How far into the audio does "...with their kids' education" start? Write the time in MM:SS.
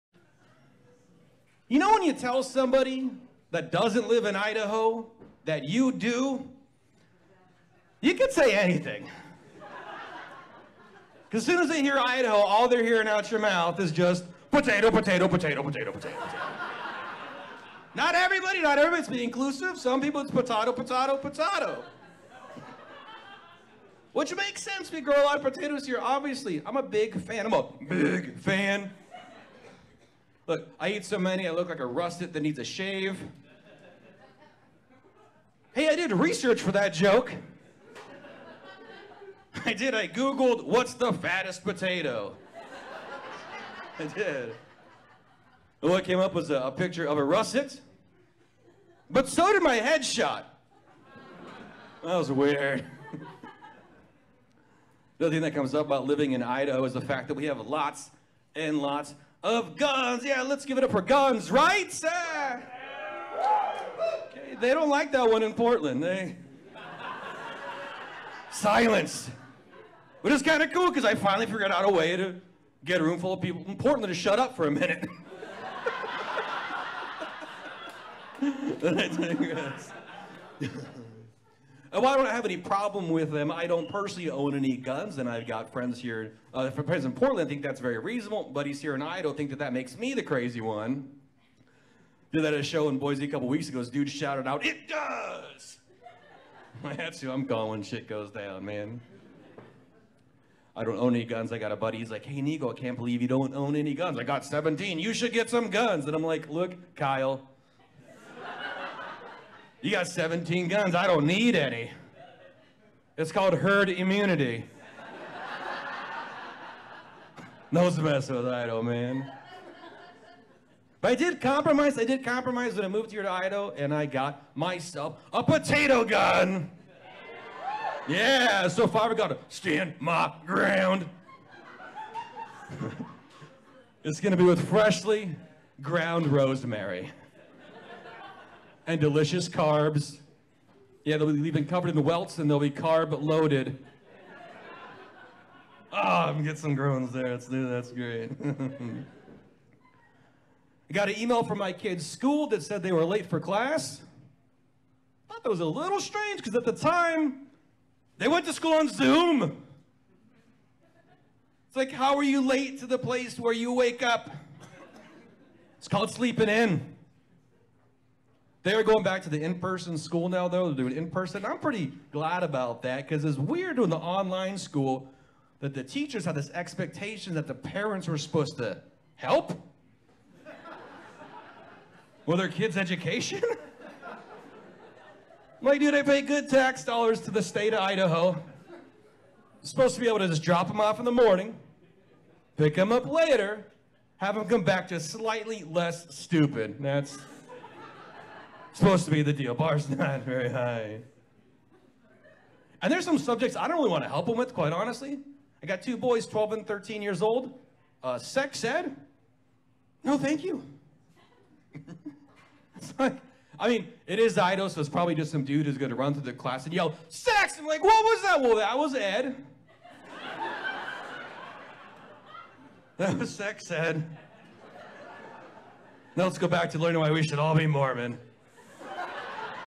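03:02.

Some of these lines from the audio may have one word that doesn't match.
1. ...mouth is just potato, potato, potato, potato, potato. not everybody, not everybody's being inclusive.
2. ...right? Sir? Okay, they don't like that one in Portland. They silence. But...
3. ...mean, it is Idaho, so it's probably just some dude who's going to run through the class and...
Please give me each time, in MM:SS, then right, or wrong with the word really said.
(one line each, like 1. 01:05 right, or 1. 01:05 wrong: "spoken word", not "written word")
1. 00:13 right
2. 01:01 right
3. 03:33 right.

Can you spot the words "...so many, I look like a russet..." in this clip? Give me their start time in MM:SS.
00:31.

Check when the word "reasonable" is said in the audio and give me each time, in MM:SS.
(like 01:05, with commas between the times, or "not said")
01:27.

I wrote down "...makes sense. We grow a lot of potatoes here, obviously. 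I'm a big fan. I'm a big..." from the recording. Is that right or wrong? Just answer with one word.
right.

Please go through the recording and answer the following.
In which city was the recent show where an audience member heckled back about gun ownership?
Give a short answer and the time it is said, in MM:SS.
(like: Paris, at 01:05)
Boise, at 01:32.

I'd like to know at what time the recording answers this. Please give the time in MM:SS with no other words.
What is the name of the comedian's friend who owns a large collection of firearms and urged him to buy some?
01:46.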